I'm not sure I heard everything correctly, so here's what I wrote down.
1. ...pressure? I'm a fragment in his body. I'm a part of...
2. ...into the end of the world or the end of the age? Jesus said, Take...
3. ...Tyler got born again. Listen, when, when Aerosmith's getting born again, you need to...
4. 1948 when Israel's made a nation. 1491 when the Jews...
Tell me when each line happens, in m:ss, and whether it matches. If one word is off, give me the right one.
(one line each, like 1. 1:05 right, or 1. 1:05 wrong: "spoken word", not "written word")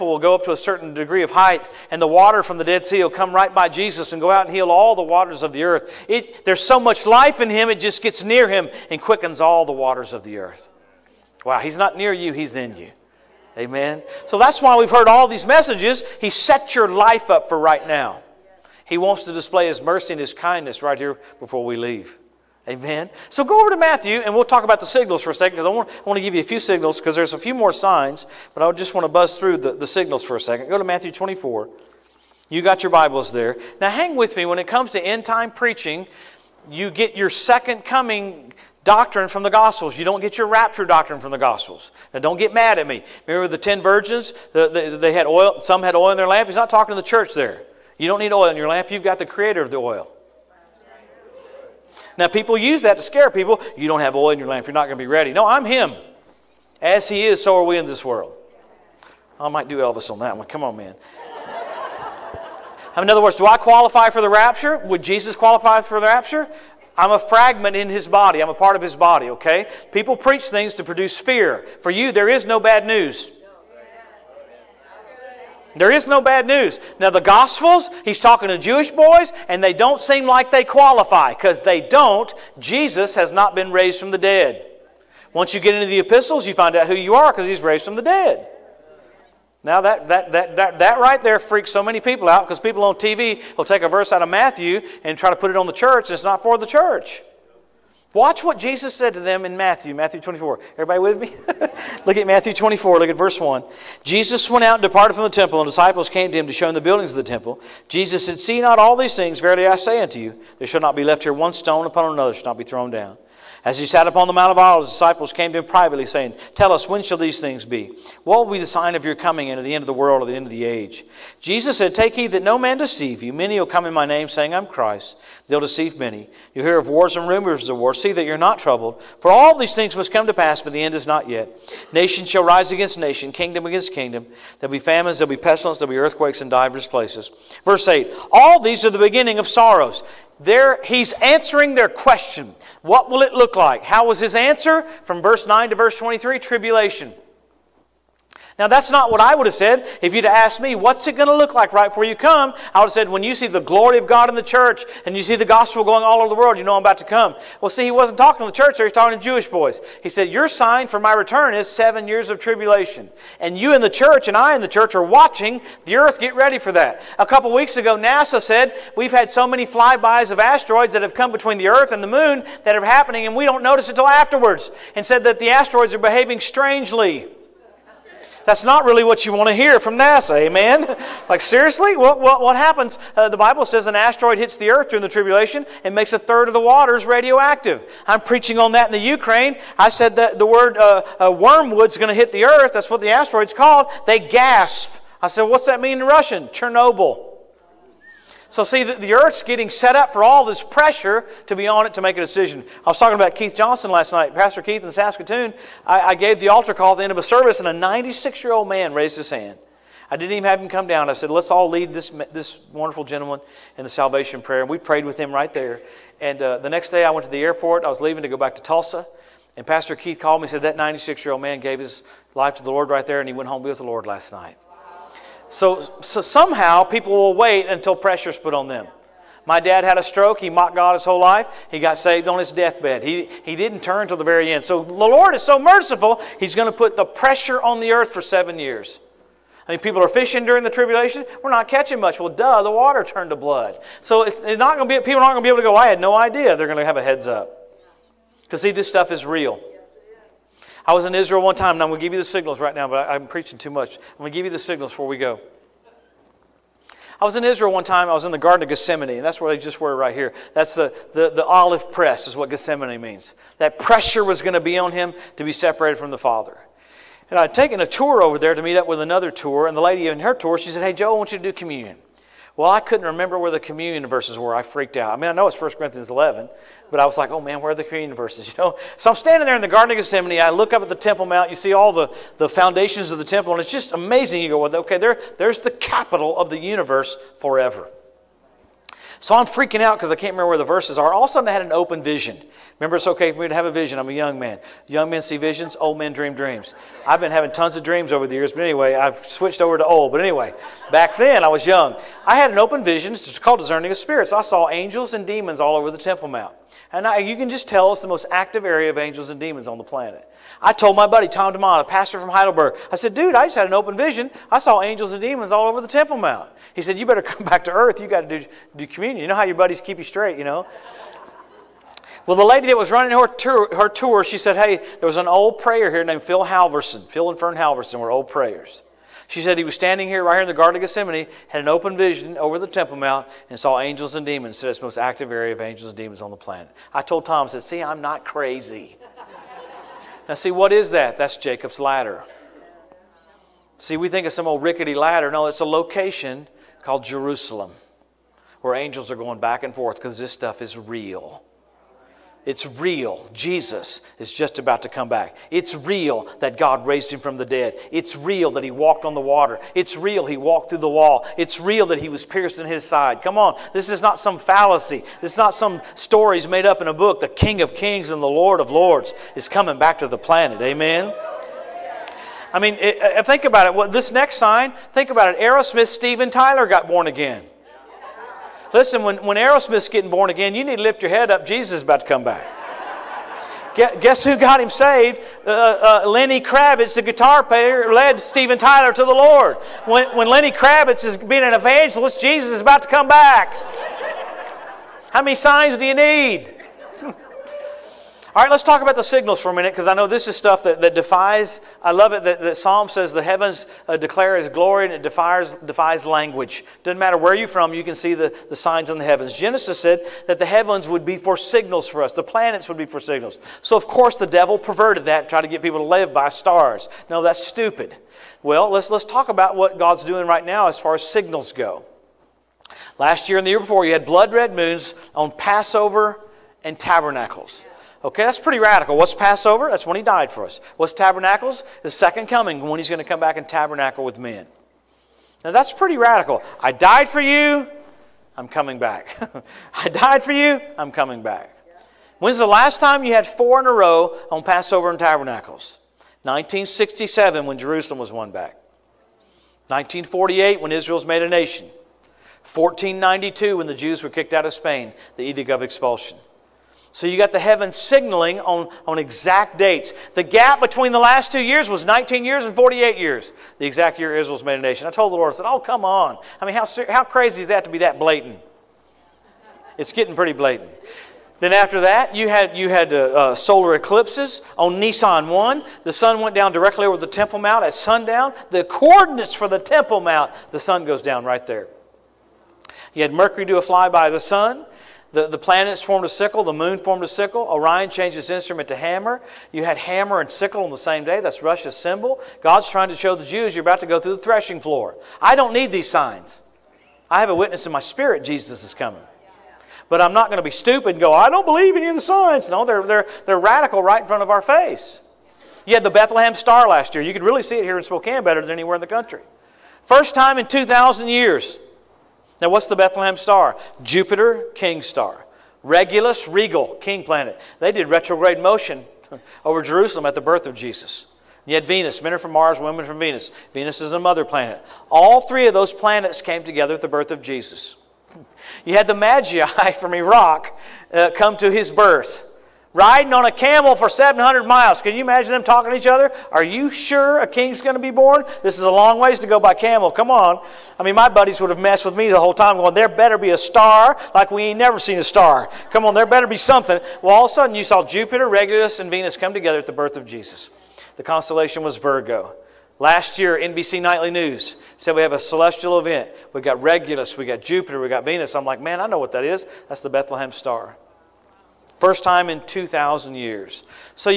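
1. 1:06 wrong: "rapture", not "pressure"
2. 1:59 right
3. 6:16 right
4. 7:29 wrong: "1492", not "1491".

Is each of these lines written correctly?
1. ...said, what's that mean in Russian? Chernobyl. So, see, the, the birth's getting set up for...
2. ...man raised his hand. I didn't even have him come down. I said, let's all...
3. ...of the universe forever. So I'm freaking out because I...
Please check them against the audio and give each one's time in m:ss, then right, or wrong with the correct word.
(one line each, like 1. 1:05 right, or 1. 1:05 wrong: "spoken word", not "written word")
1. 3:15 wrong: "earth", not "birth"
2. 3:28 right
3. 4:46 right.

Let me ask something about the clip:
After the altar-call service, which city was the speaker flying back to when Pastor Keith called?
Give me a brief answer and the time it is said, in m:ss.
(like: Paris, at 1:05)
Tulsa, at 3:38.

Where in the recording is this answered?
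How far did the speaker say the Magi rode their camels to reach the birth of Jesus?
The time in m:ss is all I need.
8:53.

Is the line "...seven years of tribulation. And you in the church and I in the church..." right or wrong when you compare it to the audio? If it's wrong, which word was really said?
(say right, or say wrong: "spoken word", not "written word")
right.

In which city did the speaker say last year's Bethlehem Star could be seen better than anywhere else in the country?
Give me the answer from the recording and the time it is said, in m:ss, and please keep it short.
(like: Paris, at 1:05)
Spokane, at 8:27.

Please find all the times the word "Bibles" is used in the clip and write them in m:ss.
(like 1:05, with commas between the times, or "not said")
0:32, 3:03.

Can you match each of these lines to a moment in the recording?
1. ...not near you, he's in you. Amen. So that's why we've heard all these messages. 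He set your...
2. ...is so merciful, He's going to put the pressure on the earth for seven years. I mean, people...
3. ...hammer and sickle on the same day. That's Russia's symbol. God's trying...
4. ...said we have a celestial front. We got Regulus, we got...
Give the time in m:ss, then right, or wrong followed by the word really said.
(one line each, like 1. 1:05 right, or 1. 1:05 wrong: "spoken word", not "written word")
1. 0:11 right
2. 3:55 right
3. 8:09 right
4. 9:14 wrong: "event", not "front".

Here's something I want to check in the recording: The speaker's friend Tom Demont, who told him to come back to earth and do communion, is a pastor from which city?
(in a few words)
Heidelberg.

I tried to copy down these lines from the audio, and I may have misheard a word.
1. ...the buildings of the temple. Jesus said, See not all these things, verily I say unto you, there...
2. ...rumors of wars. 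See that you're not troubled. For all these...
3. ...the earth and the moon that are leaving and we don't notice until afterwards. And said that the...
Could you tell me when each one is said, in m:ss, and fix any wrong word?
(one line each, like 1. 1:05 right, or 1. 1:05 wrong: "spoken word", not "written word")
1. 1:46 right
2. 2:07 right
3. 2:51 wrong: "happening", not "leaving".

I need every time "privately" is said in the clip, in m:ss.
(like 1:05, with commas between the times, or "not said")
1:55.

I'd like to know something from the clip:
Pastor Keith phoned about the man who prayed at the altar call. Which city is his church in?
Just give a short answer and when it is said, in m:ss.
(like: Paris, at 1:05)
Saskatoon, at 3:24.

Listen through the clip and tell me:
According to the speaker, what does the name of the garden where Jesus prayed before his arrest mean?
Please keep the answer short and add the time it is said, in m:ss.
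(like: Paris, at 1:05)
olive press, at 4:21.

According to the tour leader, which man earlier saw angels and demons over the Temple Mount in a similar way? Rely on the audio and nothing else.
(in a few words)
Phil Halverson.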